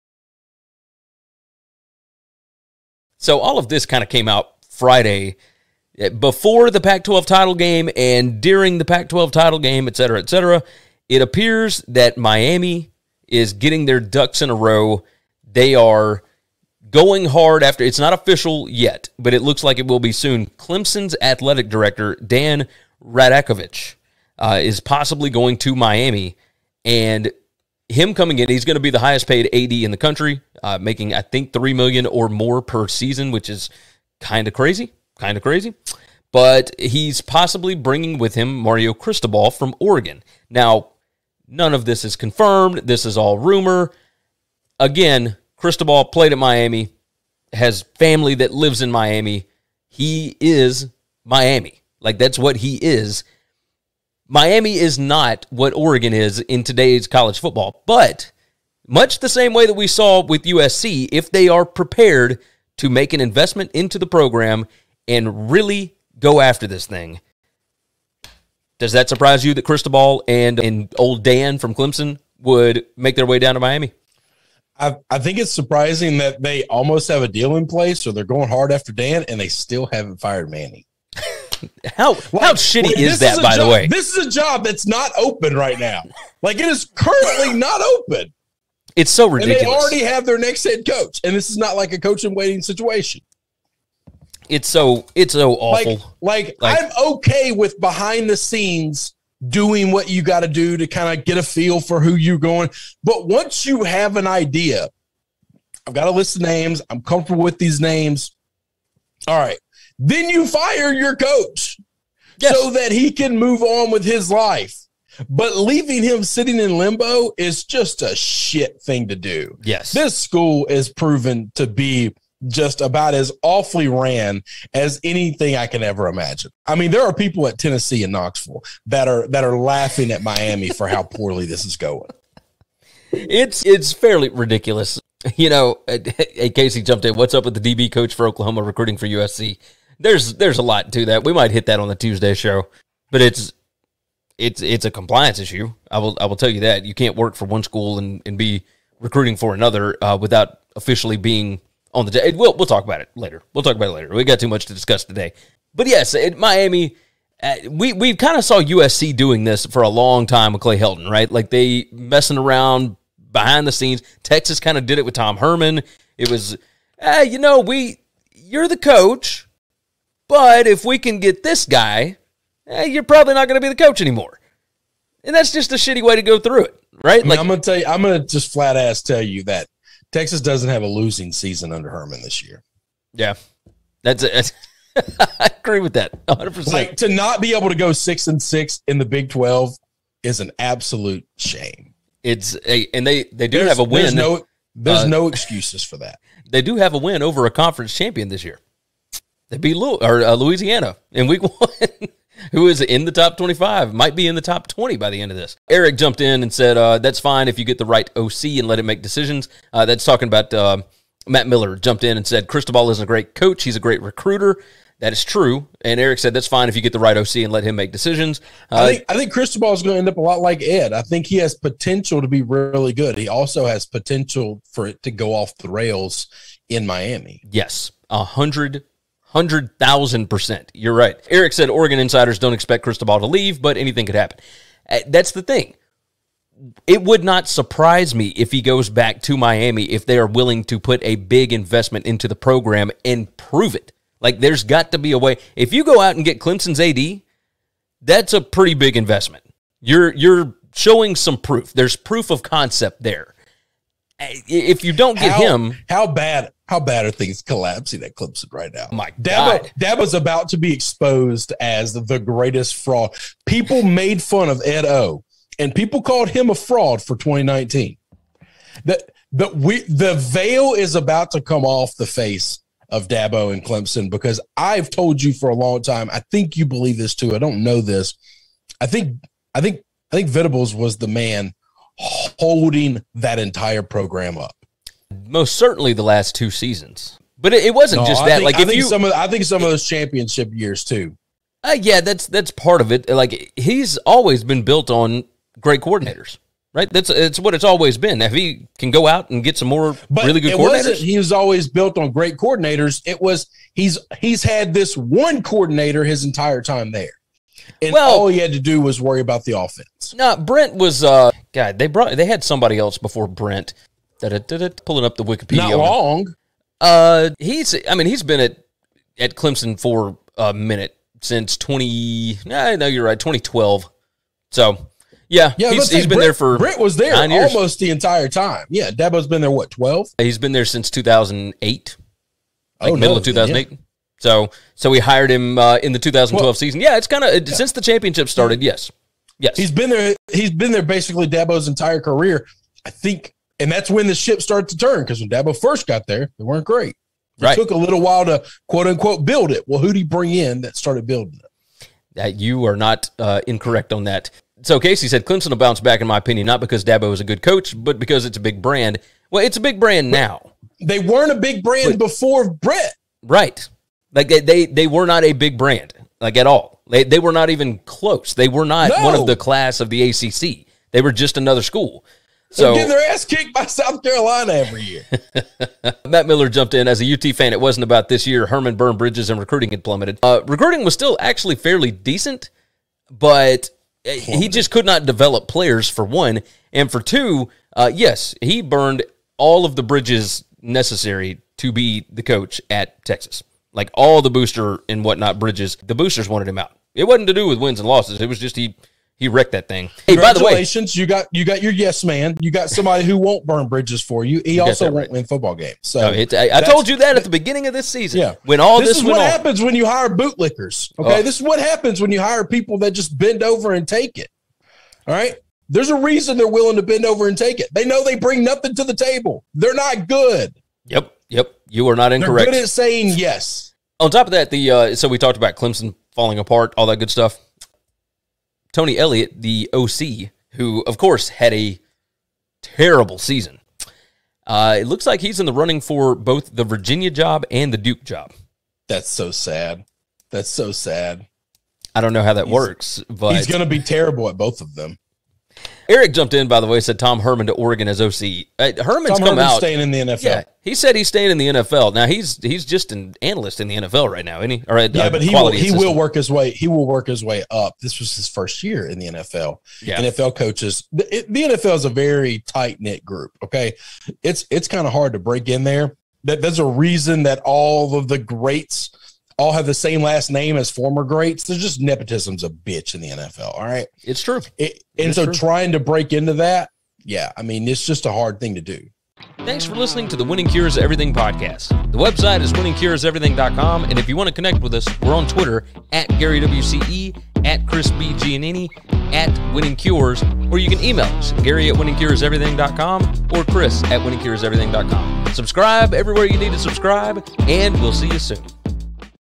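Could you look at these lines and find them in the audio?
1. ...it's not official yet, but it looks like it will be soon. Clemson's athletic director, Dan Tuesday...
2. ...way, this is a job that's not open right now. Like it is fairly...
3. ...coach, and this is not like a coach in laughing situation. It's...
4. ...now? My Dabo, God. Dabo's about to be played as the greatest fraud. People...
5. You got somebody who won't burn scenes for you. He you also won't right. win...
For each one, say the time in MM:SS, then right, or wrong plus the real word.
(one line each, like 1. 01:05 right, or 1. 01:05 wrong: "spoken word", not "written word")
1. 00:17 wrong: "Radakovich", not "Tuesday"
2. 01:23 wrong: "currently", not "fairly"
3. 01:30 wrong: "waiting", not "laughing"
4. 04:18 wrong: "exposed", not "played"
5. 06:42 wrong: "bridges", not "scenes".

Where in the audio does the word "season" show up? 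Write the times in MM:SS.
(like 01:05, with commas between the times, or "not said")
00:32, 03:01, 04:46, 05:36, 06:47, 07:13.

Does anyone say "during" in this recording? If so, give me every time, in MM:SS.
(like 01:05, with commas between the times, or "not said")
00:08.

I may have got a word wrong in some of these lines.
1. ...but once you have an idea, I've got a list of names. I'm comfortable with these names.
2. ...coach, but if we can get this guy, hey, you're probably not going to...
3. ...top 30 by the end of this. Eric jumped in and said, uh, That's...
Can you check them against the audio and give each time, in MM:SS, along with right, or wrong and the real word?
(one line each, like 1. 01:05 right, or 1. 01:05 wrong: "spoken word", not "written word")
1. 01:43 right
2. 02:48 right
3. 03:24 wrong: "20", not "30".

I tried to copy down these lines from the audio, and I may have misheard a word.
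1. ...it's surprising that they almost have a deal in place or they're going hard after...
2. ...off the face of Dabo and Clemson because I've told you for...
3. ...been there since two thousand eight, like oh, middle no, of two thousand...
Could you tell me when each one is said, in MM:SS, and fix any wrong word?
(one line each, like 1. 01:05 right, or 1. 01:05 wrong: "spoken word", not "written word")
1. 01:15 right
2. 04:31 right
3. 05:30 right.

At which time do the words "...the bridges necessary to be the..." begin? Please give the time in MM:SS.
06:29.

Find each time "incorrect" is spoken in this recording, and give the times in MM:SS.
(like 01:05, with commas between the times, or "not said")
05:53, 07:02.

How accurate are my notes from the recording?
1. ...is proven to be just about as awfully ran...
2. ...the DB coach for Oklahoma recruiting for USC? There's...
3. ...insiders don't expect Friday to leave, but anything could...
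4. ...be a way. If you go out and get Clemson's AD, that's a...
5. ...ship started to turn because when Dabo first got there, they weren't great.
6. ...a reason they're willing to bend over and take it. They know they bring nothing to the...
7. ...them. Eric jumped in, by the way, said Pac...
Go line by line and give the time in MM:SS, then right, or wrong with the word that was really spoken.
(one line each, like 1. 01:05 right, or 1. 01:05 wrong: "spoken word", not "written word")
1. 02:00 right
2. 02:17 right
3. 03:51 wrong: "Cristobal", not "Friday"
4. 04:04 right
5. 05:44 right
6. 06:55 right
7. 07:24 wrong: "Tom", not "Pac".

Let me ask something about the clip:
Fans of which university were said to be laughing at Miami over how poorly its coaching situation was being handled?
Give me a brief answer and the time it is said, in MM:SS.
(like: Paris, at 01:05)
Tennessee, at 02:07.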